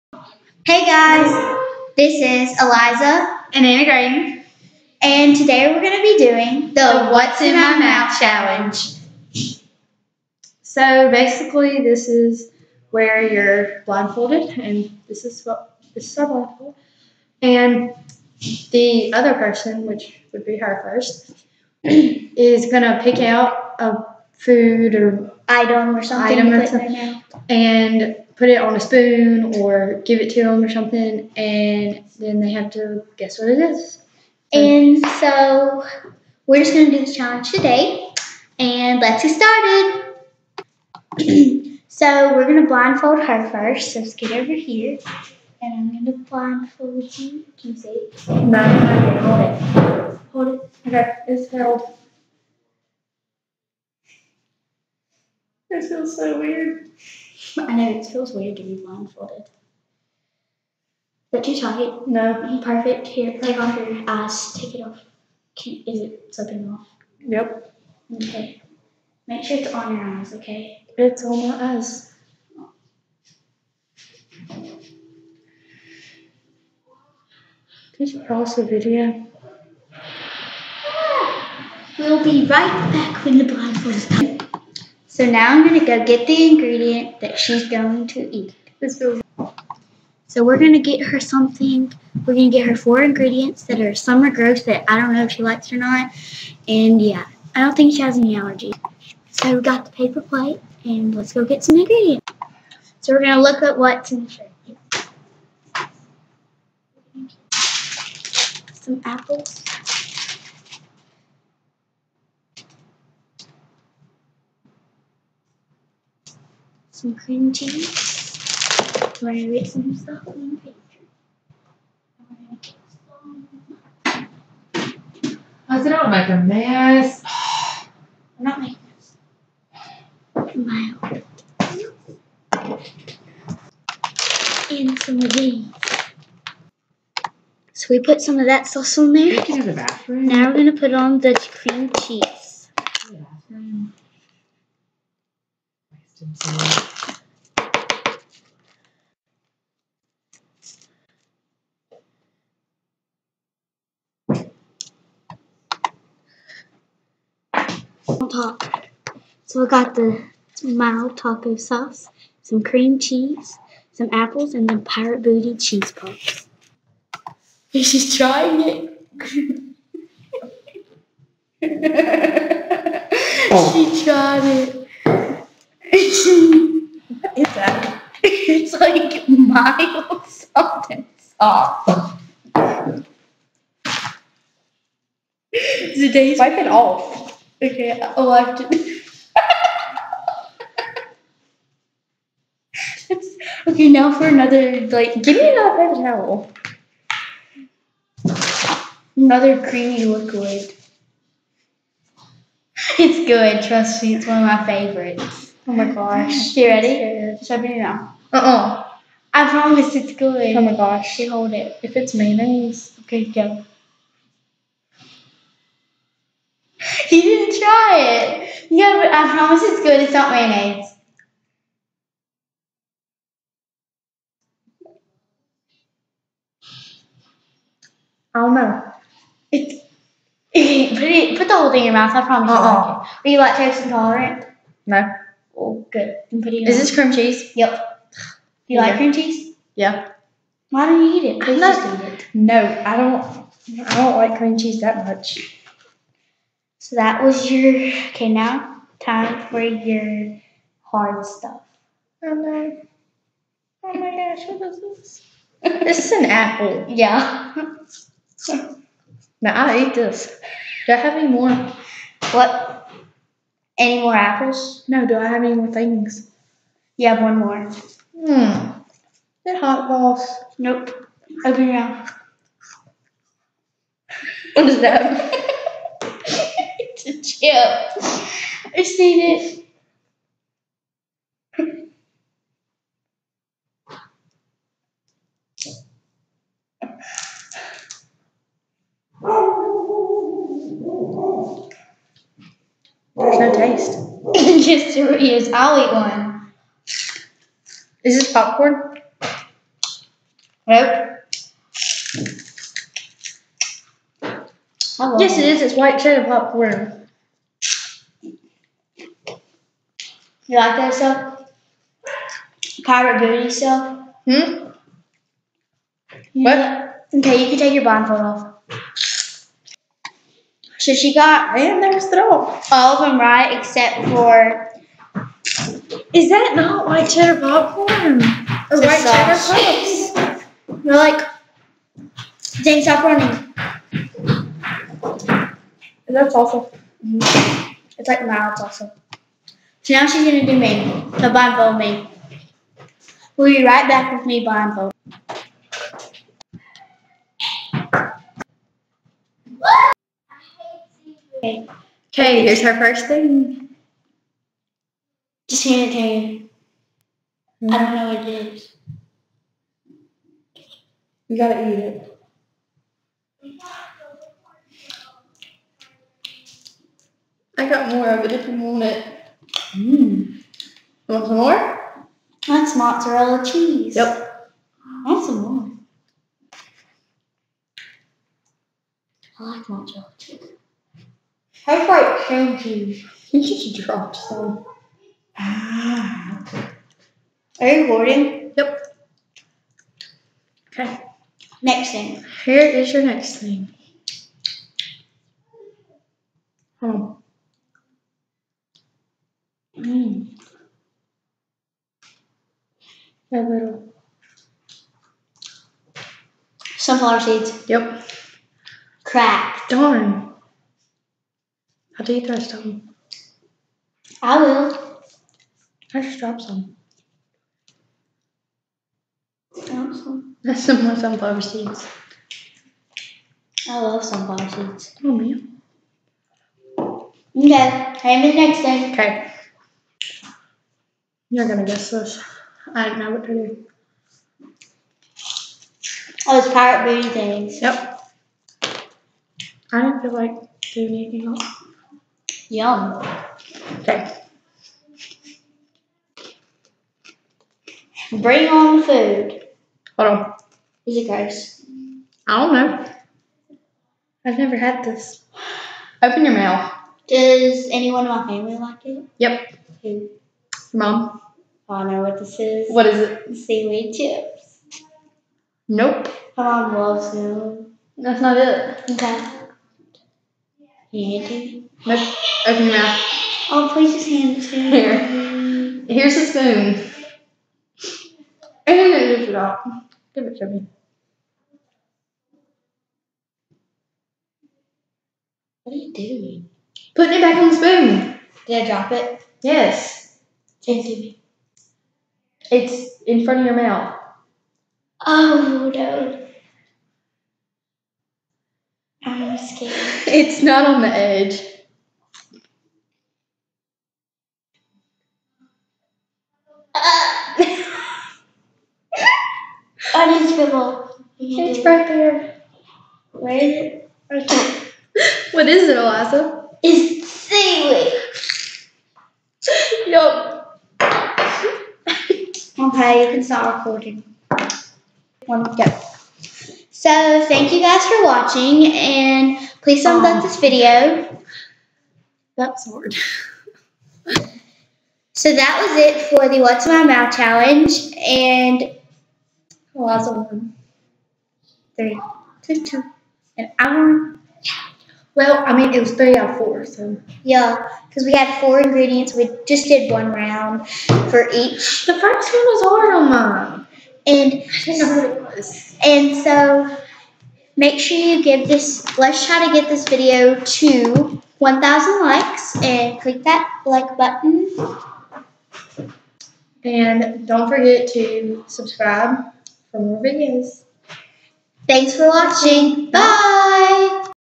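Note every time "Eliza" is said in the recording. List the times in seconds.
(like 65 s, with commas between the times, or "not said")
2 s, 515 s.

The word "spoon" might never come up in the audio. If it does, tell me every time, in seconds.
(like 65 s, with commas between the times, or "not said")
28 s, 476 s, 487 s.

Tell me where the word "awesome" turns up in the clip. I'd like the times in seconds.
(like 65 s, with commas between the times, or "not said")
338 s, 419 s.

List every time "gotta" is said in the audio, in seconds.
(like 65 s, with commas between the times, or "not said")
361 s.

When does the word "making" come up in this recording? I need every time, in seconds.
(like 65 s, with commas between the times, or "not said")
128 s.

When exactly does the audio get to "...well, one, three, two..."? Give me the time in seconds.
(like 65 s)
539 s.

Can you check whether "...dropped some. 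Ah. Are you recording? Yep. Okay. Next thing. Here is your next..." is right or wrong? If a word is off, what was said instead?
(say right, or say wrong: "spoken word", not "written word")
right.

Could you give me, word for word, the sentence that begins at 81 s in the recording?
We'll be right back when the blindfold is done.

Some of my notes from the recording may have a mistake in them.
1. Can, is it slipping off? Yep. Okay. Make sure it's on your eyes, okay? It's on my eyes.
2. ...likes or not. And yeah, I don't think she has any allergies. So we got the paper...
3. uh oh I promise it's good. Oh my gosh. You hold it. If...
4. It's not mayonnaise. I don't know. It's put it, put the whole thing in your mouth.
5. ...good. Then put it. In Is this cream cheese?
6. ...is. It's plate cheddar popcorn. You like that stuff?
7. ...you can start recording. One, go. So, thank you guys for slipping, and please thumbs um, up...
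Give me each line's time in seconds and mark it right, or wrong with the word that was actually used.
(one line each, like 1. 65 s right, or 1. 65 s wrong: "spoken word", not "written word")
1. 65 s right
2. 95 s right
3. 208 s right
4. 220 s right
5. 235 s right
6. 305 s wrong: "white", not "plate"
7. 523 s wrong: "watching", not "slipping".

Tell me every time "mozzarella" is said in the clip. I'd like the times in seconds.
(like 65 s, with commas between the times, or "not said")
372 s, 379 s.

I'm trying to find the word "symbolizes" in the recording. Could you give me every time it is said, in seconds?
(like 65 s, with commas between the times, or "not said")
not said.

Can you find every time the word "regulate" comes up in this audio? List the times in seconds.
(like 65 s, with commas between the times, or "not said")
not said.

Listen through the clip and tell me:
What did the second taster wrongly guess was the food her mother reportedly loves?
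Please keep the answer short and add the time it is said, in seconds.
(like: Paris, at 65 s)
Seaweed chips, at 463 s.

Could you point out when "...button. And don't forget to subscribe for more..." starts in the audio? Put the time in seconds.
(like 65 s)
563 s.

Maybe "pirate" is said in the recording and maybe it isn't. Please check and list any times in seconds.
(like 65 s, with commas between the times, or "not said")
164 s, 312 s, 436 s.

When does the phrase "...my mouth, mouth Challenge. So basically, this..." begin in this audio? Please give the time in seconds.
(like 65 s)
7 s.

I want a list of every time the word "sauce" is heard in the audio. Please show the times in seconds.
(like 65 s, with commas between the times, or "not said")
138 s, 161 s, 181 s.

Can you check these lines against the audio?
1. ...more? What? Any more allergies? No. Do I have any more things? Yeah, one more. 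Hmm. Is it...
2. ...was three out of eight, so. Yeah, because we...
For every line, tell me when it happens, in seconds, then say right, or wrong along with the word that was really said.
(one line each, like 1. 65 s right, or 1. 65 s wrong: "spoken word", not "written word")
1. 261 s wrong: "apples", not "allergies"
2. 545 s wrong: "four", not "eight".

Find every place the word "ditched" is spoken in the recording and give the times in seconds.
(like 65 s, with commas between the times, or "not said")
not said.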